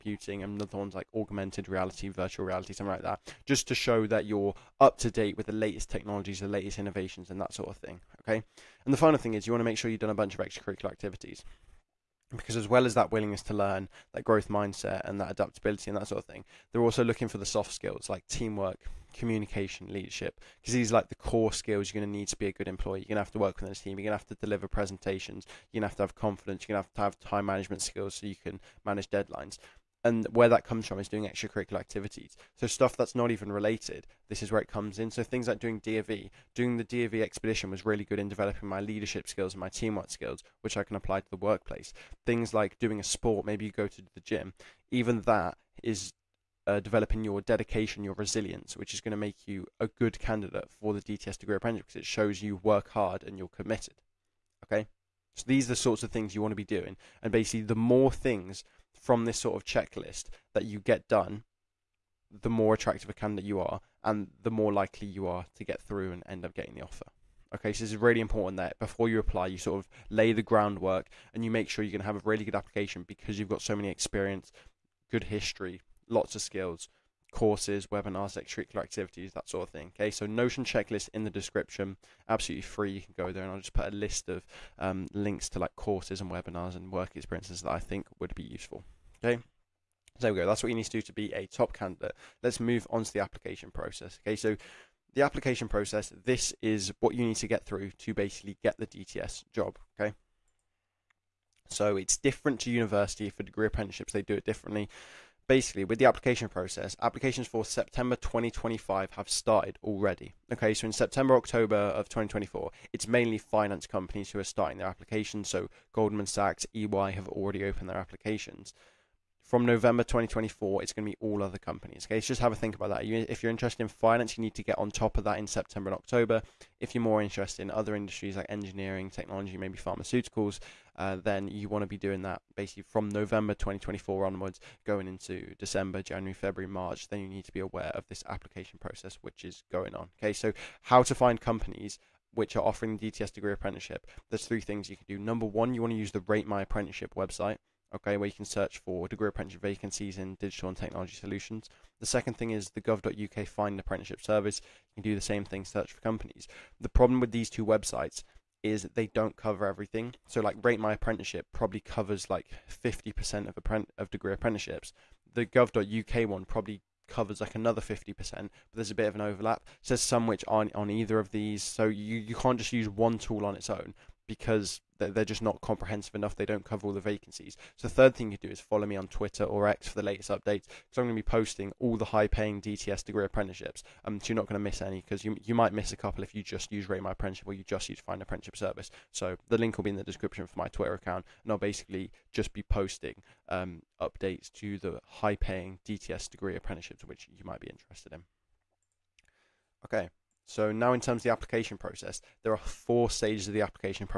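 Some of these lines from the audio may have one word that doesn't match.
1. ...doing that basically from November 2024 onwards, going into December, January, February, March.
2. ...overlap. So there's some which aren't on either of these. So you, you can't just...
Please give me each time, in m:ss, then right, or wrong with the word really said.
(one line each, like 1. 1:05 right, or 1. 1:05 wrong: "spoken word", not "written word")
1. 2:11 right
2. 2:49 right.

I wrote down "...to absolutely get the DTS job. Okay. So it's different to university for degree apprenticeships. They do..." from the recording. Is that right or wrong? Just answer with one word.
wrong.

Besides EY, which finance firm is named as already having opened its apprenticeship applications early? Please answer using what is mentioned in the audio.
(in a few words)
Goldman Sachs.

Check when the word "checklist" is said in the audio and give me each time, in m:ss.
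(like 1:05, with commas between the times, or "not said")
0:59, 1:20.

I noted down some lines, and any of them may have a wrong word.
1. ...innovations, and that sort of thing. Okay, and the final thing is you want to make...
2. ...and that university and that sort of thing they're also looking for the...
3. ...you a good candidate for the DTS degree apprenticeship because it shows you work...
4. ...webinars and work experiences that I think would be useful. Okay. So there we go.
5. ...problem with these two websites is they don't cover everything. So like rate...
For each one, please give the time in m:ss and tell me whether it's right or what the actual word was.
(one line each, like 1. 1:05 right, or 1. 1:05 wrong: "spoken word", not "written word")
1. 0:06 right
2. 0:15 wrong: "adaptability", not "university"
3. 0:49 right
4. 1:26 right
5. 2:36 right.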